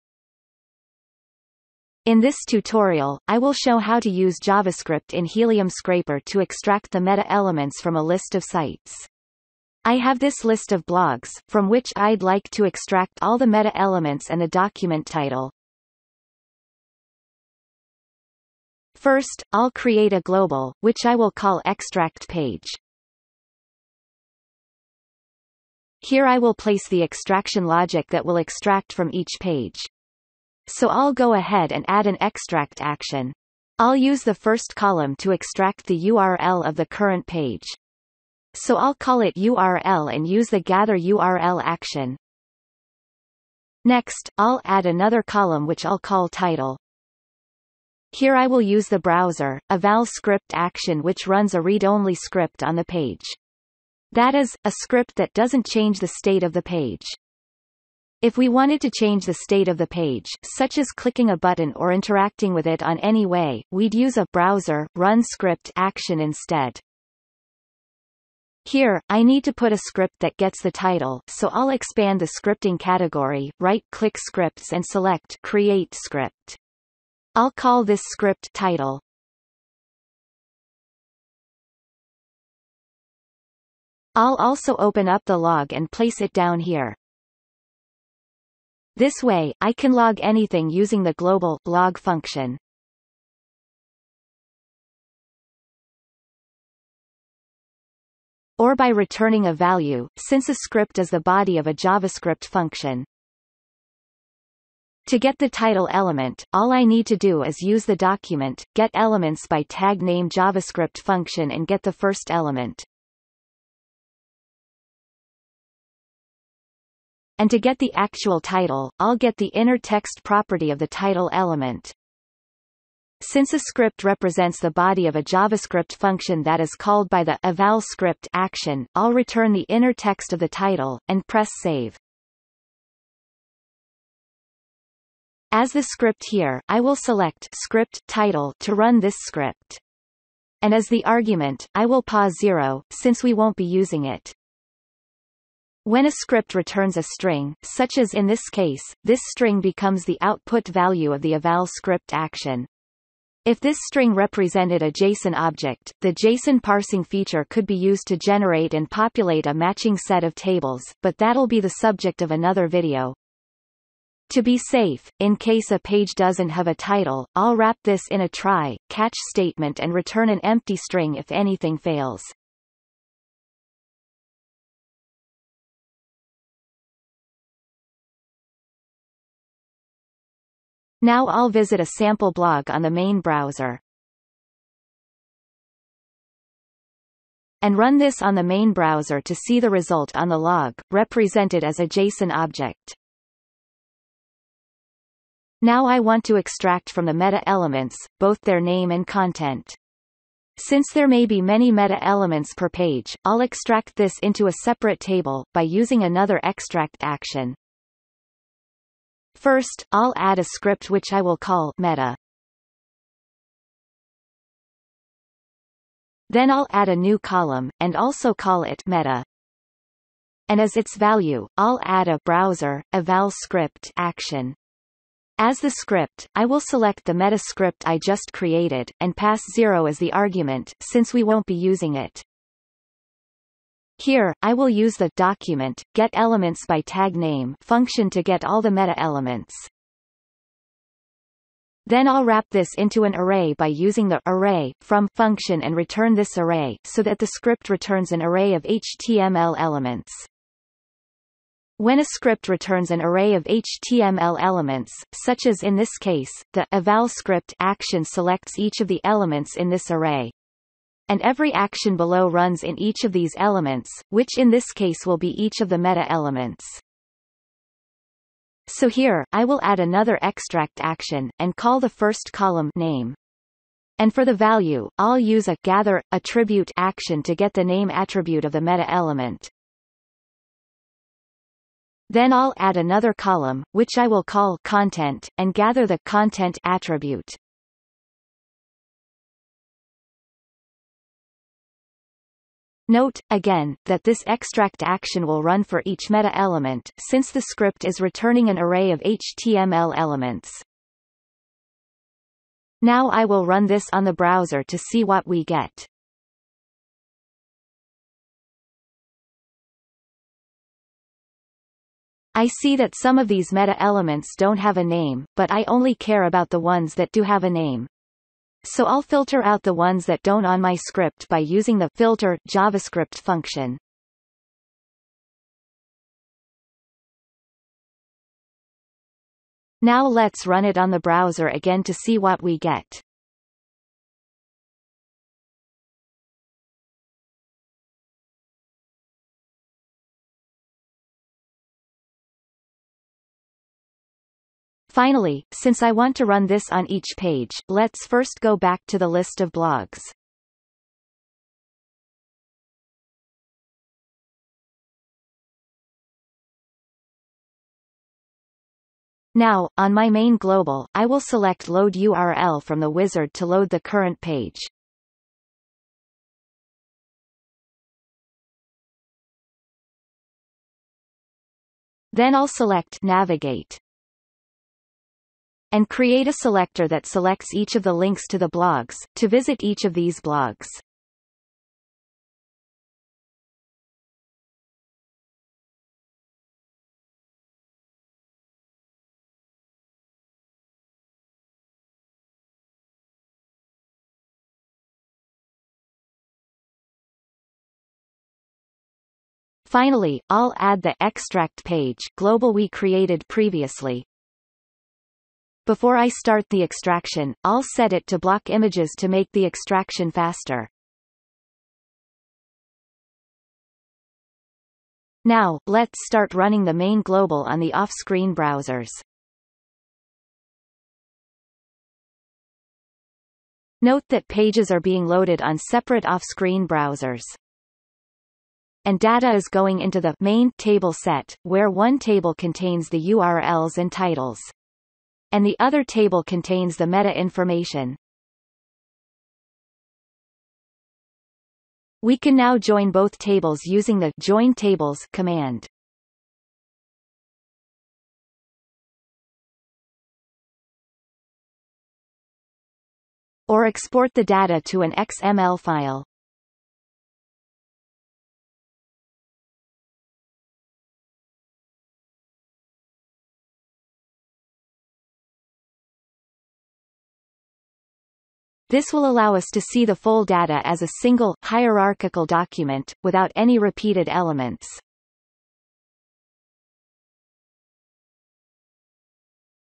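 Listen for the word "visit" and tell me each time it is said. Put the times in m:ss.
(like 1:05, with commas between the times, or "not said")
3:01, 6:19.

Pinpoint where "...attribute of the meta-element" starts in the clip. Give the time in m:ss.
4:37.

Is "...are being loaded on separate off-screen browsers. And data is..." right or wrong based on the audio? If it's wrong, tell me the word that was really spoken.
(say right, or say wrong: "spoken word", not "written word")
right.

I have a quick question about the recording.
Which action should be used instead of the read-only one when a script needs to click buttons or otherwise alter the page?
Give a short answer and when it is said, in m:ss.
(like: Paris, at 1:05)
browser run script, at 1:04.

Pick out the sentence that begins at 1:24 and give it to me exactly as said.
I'll also open up the log and place it down here.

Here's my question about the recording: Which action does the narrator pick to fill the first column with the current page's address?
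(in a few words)
gather URL.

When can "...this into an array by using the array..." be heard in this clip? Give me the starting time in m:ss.
4:02.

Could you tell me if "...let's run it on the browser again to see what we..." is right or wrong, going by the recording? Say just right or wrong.
right.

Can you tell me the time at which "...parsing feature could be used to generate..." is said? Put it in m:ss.
2:36.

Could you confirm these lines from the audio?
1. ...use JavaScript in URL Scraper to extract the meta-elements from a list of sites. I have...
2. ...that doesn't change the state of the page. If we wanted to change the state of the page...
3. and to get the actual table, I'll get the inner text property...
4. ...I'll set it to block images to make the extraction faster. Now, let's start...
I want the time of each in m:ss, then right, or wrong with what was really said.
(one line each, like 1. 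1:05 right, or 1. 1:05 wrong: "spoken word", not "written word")
1. 0:04 wrong: "Helium", not "URL"
2. 0:55 right
3. 1:57 wrong: "title", not "table"
4. 6:47 right.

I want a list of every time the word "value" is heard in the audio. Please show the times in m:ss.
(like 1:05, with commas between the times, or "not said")
1:39, 2:30, 3:40, 4:34.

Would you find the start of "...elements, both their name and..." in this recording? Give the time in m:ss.
3:17.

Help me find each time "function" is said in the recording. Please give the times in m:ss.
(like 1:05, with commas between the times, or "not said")
1:31, 1:42, 1:50, 2:05, 3:57, 4:05, 5:23.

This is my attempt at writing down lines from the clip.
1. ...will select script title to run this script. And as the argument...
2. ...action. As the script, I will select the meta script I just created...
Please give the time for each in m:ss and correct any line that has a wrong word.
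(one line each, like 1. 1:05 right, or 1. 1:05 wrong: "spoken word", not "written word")
1. 2:16 right
2. 3:43 right.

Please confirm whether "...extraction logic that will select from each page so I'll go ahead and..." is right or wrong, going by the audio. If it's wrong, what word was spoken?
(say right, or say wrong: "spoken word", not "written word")
wrong: "extract", not "select".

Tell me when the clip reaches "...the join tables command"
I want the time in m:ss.
7:23.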